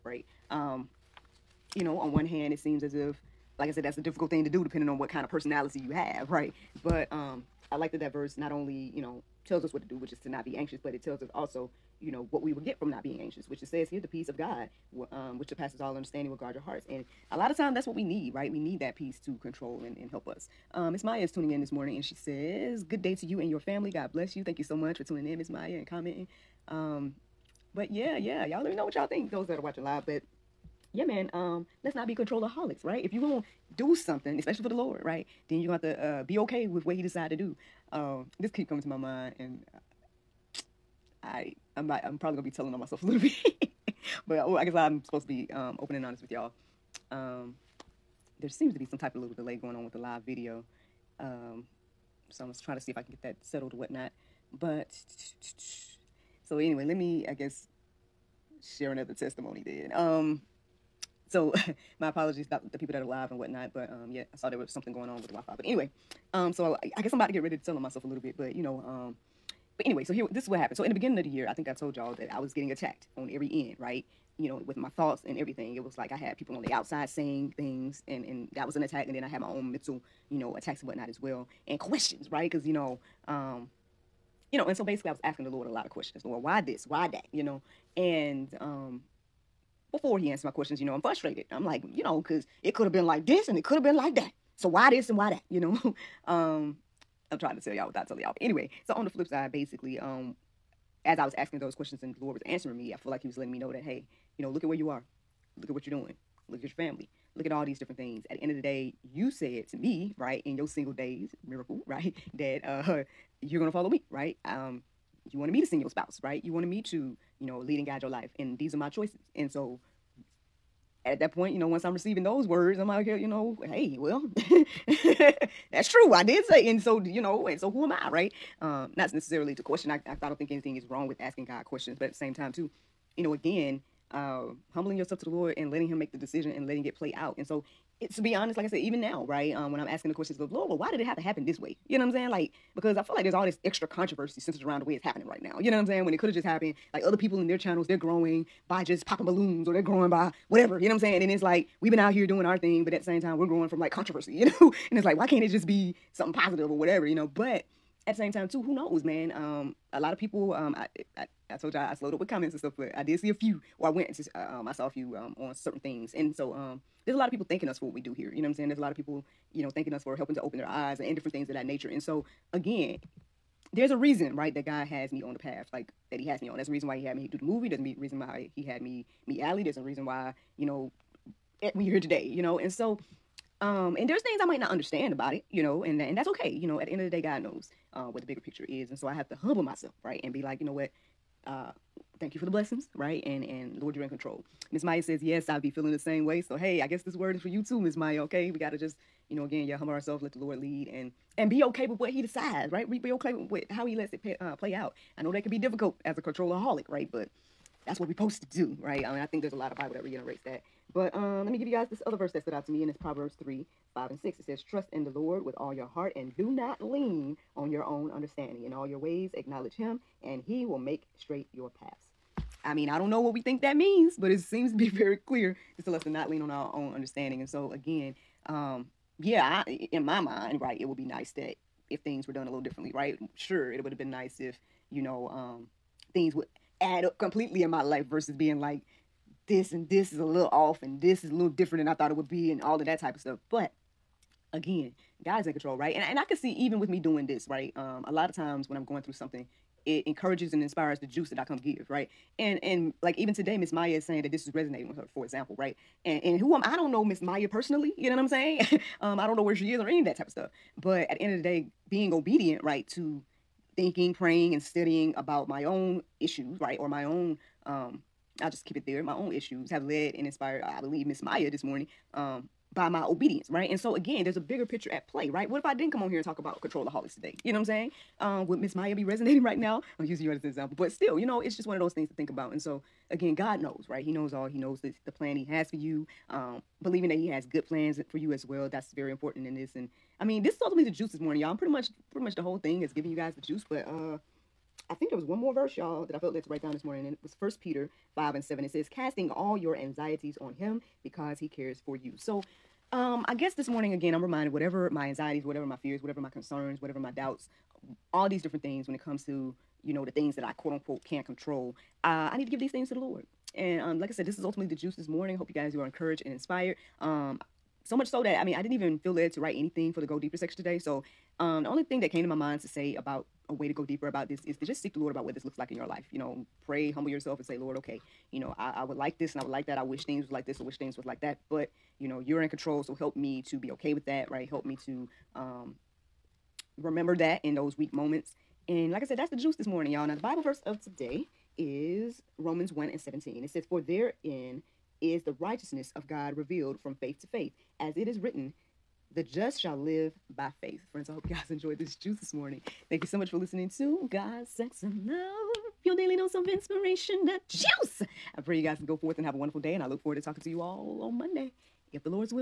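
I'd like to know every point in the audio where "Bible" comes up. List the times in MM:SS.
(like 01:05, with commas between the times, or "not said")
03:29, 05:40.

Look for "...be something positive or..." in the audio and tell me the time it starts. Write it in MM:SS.
02:35.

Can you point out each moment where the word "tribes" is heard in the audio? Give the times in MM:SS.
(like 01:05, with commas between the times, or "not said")
not said.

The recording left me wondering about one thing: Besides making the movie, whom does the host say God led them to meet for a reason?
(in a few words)
Allie.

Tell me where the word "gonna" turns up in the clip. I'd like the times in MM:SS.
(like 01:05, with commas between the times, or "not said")
00:42, 01:53.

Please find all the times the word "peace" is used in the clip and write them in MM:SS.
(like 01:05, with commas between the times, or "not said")
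00:14, 00:18.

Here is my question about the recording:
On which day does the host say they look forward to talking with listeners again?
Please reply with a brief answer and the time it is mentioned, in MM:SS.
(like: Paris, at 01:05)
Monday, at 06:01.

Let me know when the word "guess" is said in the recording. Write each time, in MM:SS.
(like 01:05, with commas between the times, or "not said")
00:44, 00:57, 01:07, 03:16, 05:03.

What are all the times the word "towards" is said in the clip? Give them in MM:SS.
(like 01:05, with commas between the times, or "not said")
not said.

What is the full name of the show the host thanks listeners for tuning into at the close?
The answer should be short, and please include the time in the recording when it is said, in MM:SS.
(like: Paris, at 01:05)
God, Sex, and Love, at 05:54.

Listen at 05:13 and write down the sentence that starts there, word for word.
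And um, like I said, this is ultimately the juice this morning.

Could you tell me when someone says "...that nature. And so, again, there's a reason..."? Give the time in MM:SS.
02:51.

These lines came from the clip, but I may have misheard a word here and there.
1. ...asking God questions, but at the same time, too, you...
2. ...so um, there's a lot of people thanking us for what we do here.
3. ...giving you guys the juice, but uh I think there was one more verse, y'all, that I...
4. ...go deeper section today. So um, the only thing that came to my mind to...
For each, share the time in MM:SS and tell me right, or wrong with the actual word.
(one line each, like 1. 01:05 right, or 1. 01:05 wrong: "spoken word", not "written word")
1. 02:11 right
2. 02:46 right
3. 04:52 right
4. 05:20 right.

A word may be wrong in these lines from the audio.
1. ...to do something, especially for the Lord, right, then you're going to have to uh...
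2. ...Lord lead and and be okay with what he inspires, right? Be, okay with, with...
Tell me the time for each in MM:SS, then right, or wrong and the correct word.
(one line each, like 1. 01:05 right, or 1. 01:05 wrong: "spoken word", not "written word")
1. 00:33 right
2. 03:20 wrong: "decides", not "inspires".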